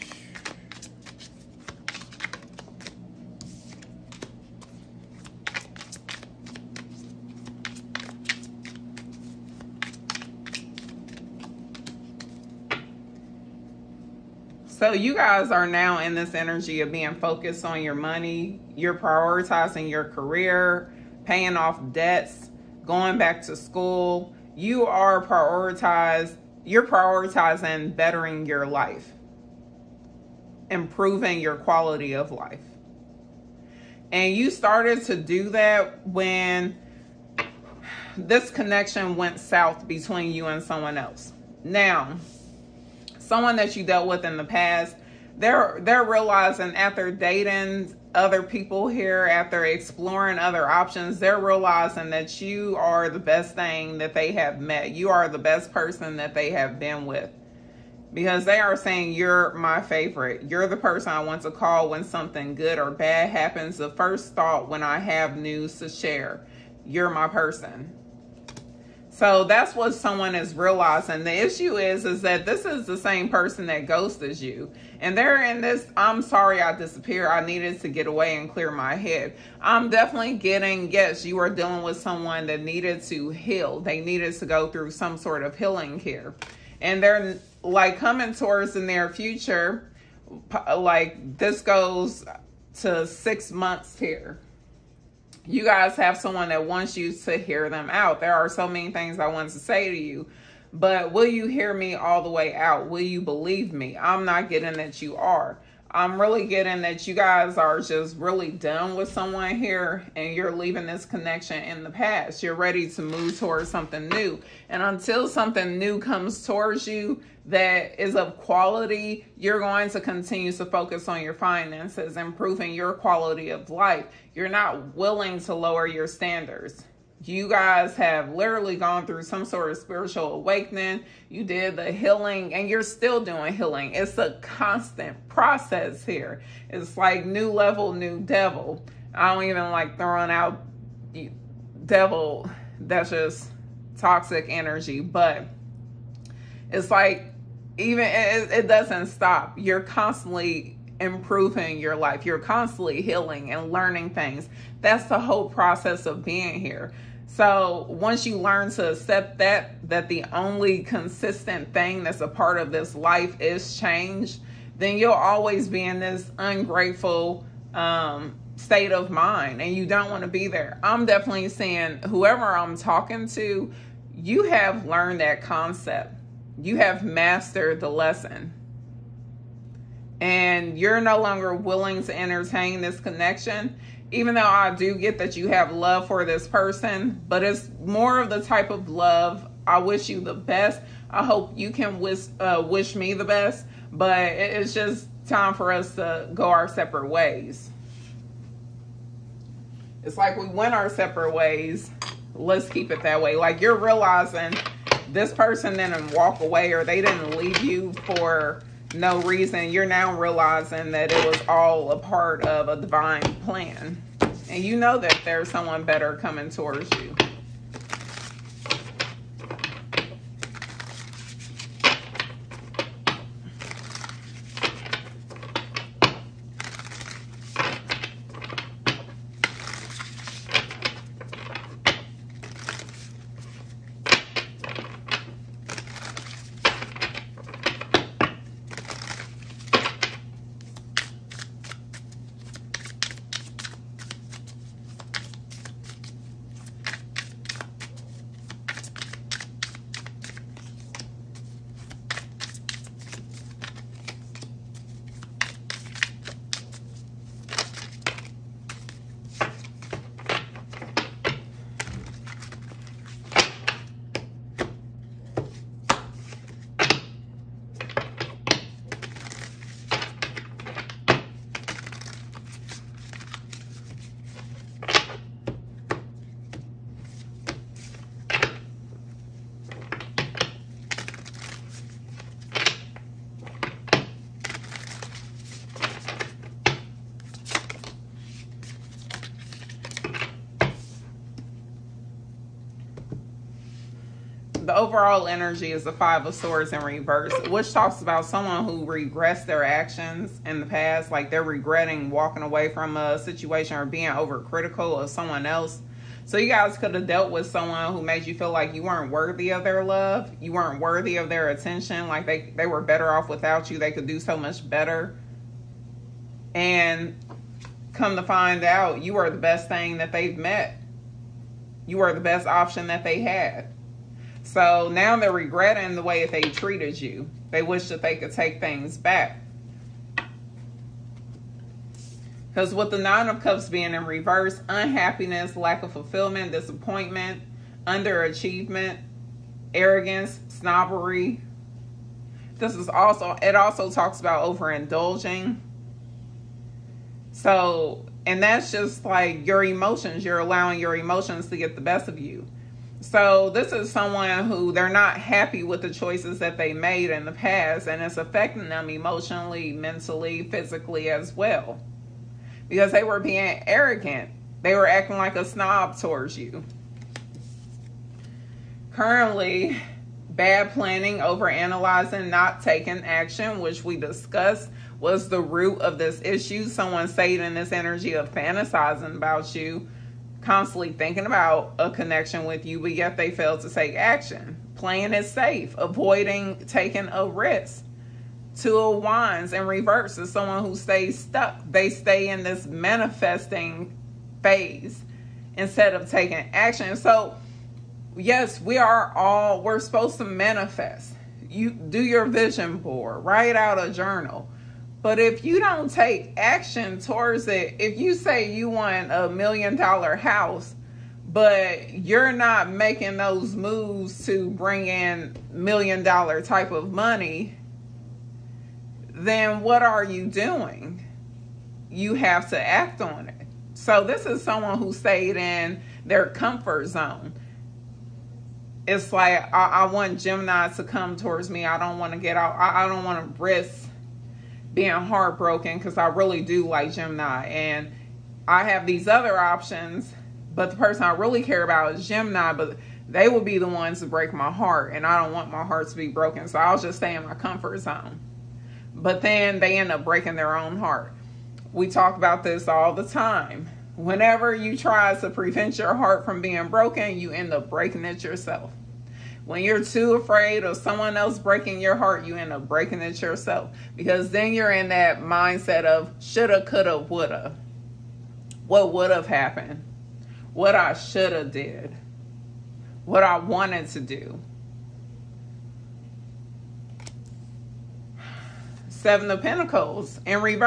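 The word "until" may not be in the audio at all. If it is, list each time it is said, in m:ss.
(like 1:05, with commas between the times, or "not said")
1:54.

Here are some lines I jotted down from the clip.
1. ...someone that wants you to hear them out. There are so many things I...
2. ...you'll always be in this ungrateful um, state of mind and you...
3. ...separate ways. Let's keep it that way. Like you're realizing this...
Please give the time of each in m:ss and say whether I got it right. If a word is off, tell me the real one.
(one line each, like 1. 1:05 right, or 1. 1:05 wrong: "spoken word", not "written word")
1. 1:36 right
2. 2:44 right
3. 3:20 right.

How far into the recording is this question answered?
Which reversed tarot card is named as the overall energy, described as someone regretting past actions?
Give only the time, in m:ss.
4:55.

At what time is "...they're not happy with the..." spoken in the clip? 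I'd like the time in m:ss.
5:54.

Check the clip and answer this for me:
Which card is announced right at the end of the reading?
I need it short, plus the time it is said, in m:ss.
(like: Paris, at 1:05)
Seven of Pentacles, at 7:58.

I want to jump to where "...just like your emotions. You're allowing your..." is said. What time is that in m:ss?
5:48.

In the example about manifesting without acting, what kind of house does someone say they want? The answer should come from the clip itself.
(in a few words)
million dollar house.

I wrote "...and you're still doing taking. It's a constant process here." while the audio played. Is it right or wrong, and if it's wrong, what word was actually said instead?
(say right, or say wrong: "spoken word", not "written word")
wrong: "healing", not "taking".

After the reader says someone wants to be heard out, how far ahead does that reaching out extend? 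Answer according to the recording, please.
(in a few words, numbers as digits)
6 months.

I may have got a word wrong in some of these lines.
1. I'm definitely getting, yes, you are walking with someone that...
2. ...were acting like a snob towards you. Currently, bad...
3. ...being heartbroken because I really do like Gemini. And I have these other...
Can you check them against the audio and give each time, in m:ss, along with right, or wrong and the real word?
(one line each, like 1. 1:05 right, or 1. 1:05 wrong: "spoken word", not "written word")
1. 1:19 wrong: "dealing", not "walking"
2. 6:04 right
3. 7:14 right.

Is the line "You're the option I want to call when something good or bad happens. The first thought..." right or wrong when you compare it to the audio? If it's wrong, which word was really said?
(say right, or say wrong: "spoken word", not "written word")
wrong: "person", not "option".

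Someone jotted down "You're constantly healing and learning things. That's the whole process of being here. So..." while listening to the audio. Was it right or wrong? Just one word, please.
right.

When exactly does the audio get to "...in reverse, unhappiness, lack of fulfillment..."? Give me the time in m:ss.
5:33.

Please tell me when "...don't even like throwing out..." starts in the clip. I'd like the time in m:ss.
2:19.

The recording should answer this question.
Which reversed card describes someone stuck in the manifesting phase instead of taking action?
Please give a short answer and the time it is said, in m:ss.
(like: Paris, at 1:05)
Two of Wands, at 6:28.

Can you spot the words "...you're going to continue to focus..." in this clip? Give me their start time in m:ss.
1:59.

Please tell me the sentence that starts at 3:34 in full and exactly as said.
And you know that there's someone better coming towards you.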